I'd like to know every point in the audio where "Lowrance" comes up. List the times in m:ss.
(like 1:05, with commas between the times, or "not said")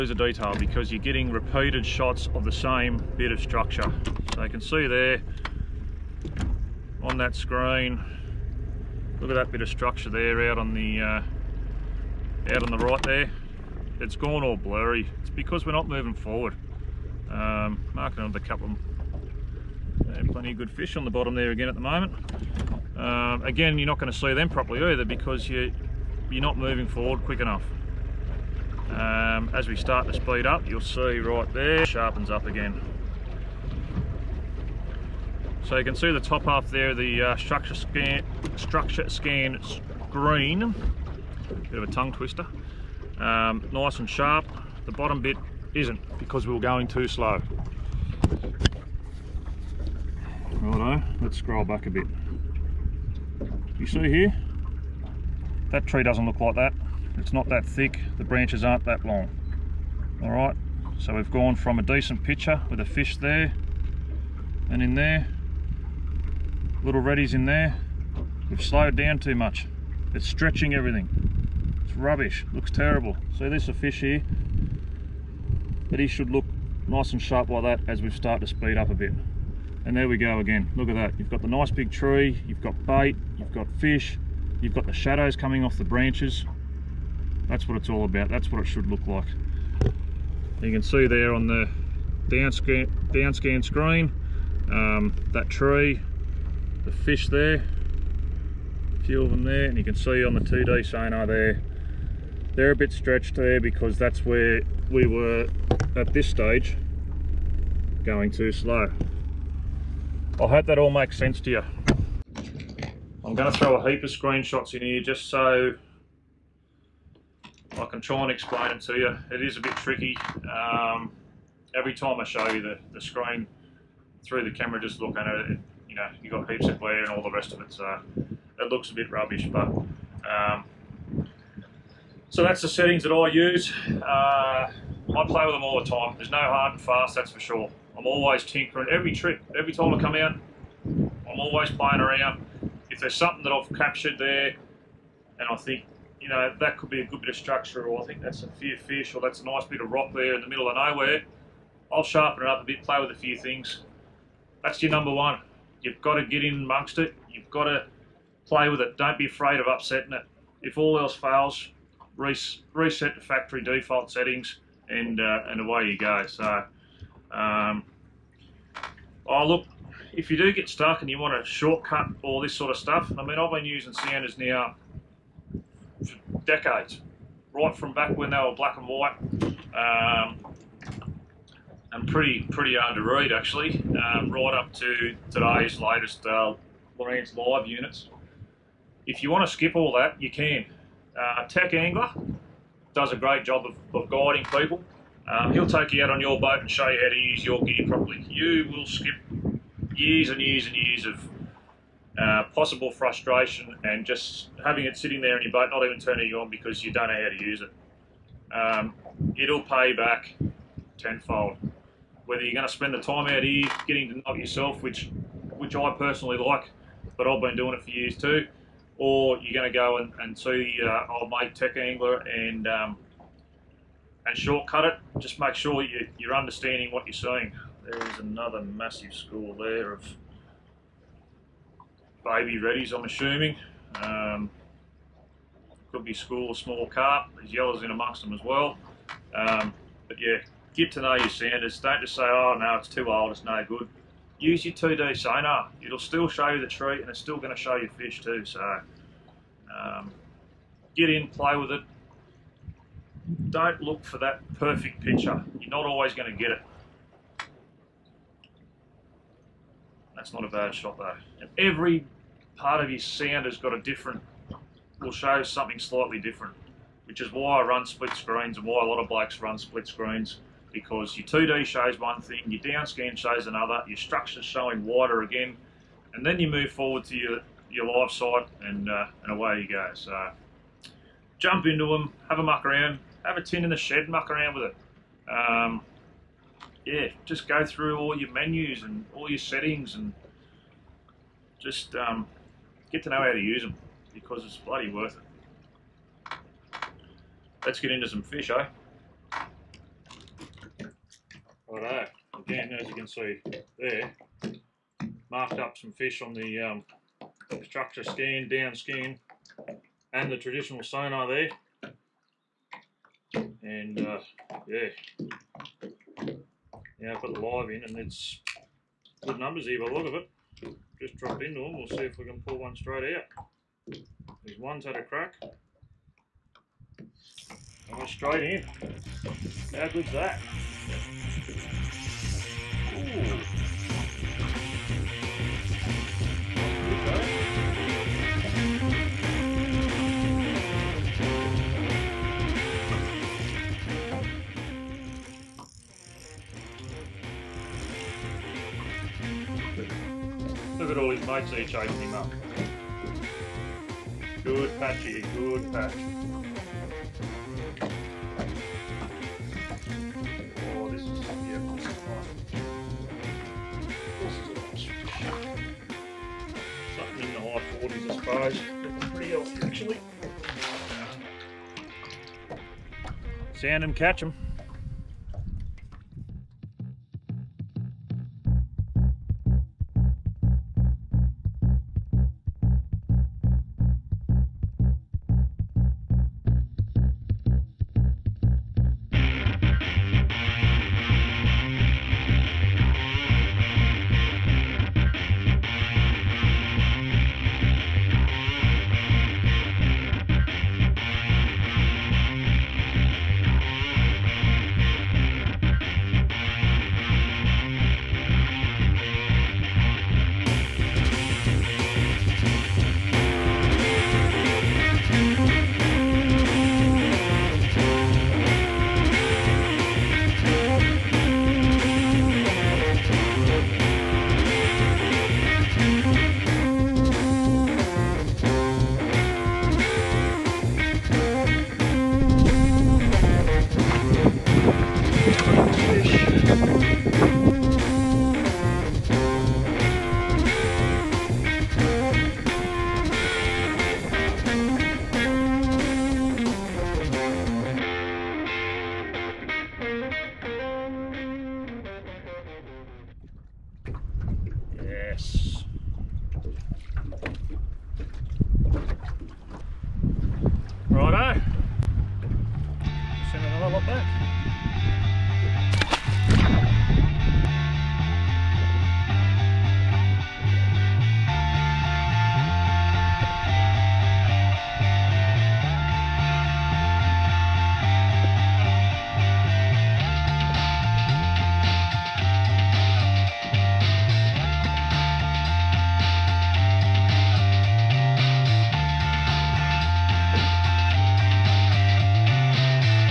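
3:06.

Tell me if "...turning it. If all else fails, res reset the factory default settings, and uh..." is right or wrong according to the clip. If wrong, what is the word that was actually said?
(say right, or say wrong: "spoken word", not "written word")
wrong: "upsetting", not "turning".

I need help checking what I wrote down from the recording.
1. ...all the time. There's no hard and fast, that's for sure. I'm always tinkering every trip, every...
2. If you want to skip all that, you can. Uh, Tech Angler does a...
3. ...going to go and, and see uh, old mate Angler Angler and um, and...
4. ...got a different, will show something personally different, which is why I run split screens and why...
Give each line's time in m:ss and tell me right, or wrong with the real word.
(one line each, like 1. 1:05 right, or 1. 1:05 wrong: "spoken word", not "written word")
1. 2:15 right
2. 3:09 right
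3. 3:39 wrong: "Tech", not "Angler"
4. 4:23 wrong: "slightly", not "personally".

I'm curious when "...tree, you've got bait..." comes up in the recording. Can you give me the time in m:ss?
1:21.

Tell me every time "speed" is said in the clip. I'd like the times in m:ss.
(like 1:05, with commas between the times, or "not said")
0:30, 1:18.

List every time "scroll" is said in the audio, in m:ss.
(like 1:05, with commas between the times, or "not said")
0:51.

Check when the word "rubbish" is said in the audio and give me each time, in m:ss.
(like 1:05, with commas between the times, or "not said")
1:11, 2:09.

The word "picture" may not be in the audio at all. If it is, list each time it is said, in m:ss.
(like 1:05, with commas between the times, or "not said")
1:02, 4:15.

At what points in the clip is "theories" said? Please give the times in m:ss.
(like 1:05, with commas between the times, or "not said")
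not said.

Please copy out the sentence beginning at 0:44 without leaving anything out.
The bottom bit isn't because we were going too slow.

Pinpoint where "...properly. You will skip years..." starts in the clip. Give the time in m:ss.
3:17.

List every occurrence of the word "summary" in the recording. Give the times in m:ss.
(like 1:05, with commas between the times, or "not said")
not said.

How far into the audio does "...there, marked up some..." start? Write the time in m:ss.
5:03.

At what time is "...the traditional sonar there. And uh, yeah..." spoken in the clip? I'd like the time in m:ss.
5:10.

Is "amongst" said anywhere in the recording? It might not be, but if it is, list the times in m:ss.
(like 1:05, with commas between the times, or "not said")
2:36, 3:57.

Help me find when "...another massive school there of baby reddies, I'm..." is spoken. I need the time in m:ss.
3:48.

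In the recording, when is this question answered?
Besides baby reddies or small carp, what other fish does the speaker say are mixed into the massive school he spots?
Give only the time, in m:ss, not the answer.
3:57.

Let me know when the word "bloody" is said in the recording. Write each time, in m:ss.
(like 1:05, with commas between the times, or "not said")
4:54.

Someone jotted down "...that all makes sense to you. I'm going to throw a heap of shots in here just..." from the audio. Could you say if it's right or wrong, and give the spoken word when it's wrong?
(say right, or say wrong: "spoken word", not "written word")
wrong: "screenshots", not "shots".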